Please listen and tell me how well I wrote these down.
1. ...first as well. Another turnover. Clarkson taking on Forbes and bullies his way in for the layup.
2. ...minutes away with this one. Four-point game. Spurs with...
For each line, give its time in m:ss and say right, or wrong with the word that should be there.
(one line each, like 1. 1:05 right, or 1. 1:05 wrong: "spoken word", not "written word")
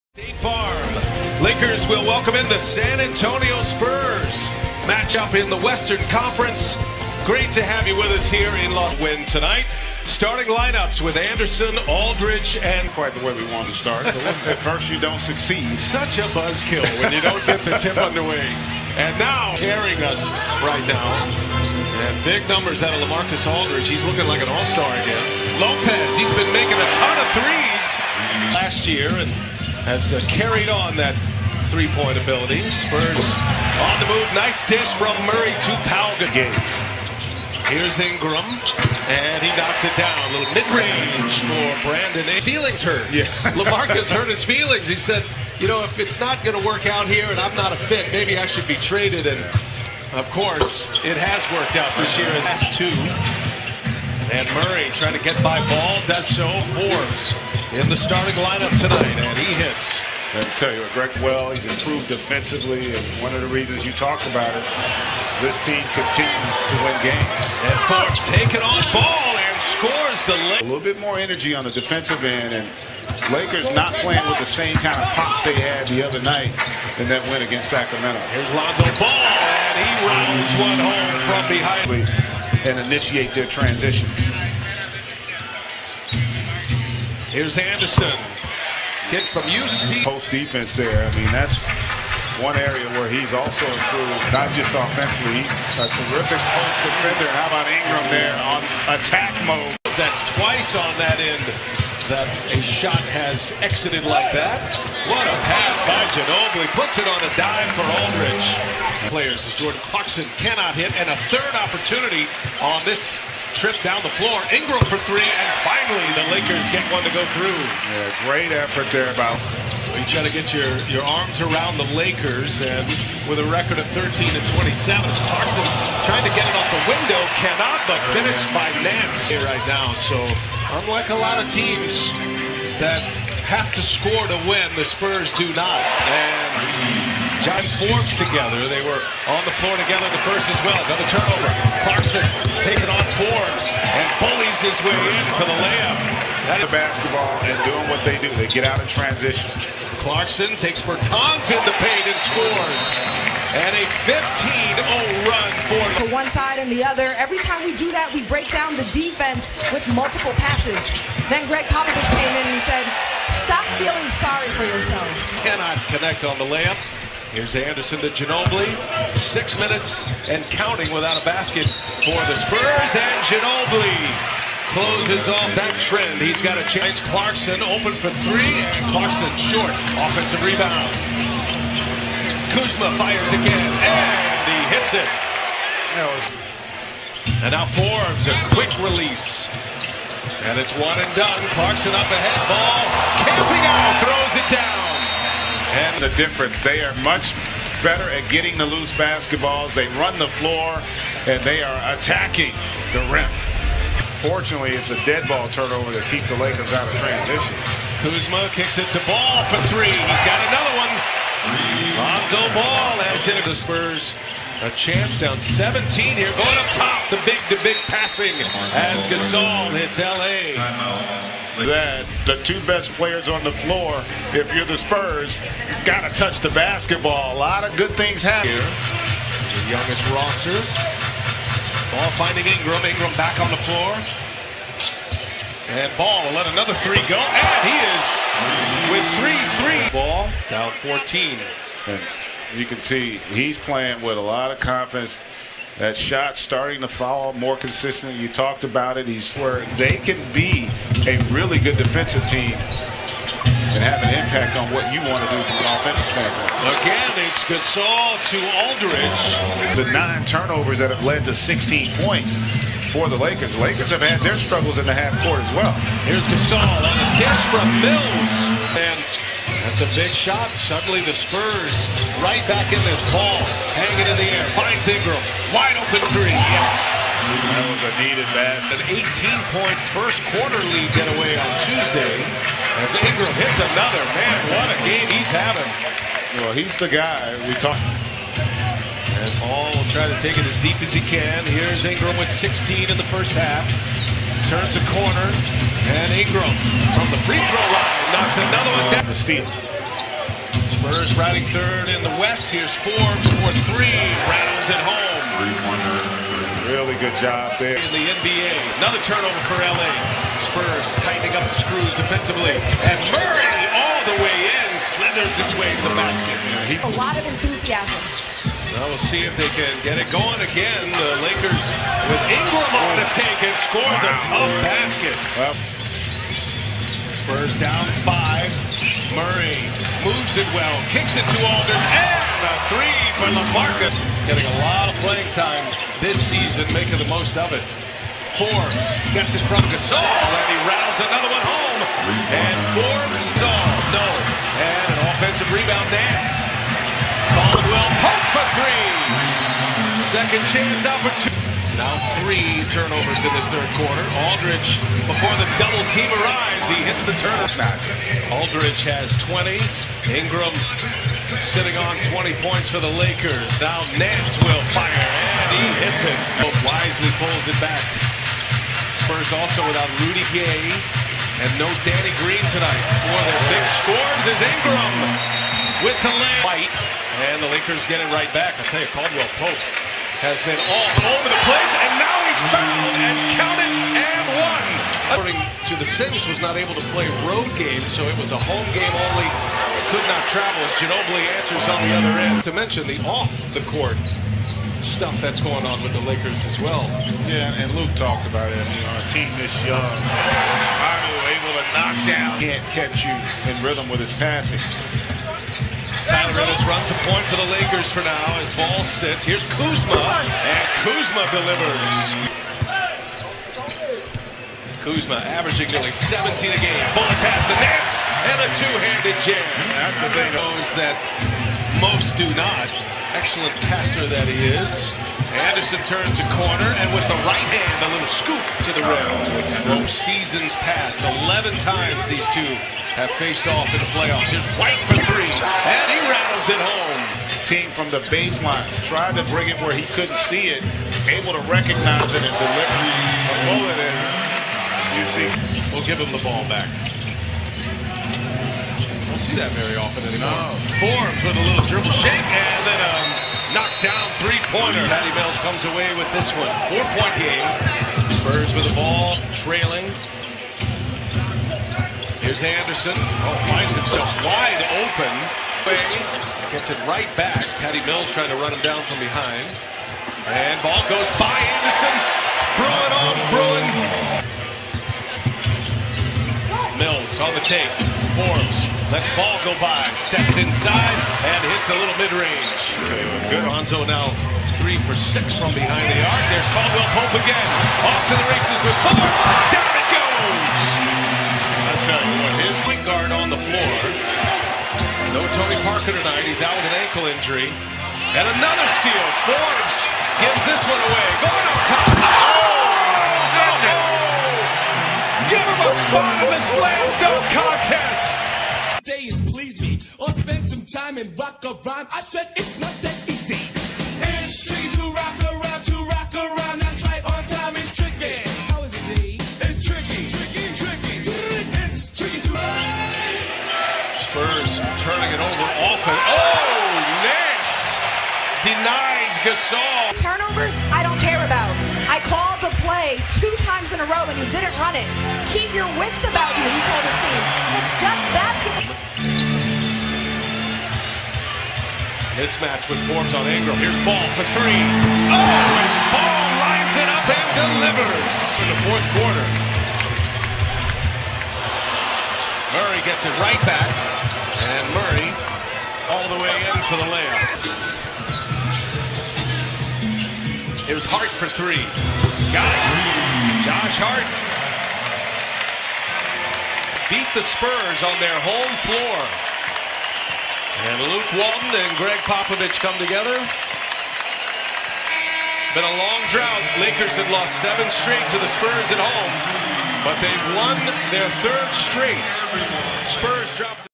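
1. 2:20 right
2. 7:35 wrong: "comes", not "minutes".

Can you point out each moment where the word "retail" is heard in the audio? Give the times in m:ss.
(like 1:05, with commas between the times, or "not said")
not said.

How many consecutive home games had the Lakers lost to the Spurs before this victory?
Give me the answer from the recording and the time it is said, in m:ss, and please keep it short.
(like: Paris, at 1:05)
7, at 9:37.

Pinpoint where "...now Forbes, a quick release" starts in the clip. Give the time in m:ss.
3:07.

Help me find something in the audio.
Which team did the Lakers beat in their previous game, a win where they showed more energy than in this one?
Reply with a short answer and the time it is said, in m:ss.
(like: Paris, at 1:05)
Sacramento, at 1:17.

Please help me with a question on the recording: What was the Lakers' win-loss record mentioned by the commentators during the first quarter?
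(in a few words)
13-27.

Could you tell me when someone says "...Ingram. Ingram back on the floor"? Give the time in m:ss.
3:52.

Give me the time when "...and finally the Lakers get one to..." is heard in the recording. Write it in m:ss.
1:55.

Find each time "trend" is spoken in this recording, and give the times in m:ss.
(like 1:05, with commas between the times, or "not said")
2:55.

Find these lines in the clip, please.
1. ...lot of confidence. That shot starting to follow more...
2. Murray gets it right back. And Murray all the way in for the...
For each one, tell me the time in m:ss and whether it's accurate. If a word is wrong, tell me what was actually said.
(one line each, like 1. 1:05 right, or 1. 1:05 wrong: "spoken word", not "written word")
1. 4:04 right
2. 9:12 right.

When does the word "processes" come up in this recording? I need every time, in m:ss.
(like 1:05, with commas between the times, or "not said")
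not said.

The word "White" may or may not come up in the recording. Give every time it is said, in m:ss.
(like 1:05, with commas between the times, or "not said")
6:16, 7:14.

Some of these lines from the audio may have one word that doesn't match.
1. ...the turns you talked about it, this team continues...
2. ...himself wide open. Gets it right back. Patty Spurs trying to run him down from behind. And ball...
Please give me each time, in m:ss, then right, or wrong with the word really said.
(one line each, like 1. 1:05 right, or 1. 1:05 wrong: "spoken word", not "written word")
1. 1:03 wrong: "reasons", not "turns"
2. 7:43 wrong: "Mills", not "Spurs".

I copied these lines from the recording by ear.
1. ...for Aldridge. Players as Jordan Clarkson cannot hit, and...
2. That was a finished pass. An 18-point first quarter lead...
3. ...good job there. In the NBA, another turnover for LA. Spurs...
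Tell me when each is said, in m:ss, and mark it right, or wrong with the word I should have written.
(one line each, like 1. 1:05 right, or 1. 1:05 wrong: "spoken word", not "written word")
1. 1:47 right
2. 4:37 wrong: "needed", not "finished"
3. 5:07 right.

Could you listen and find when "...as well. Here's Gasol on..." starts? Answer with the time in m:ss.
4:25.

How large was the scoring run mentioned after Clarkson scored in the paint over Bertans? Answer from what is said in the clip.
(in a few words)
15-0.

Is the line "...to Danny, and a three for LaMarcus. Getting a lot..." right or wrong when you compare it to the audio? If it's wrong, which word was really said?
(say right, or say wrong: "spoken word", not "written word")
wrong: "Alders", not "Danny".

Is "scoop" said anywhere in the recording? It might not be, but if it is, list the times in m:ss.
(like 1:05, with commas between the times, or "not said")
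7:08.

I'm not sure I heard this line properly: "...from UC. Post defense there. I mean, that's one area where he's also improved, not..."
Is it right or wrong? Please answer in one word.
right.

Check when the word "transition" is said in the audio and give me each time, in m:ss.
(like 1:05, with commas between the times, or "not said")
1:23, 2:28, 3:27.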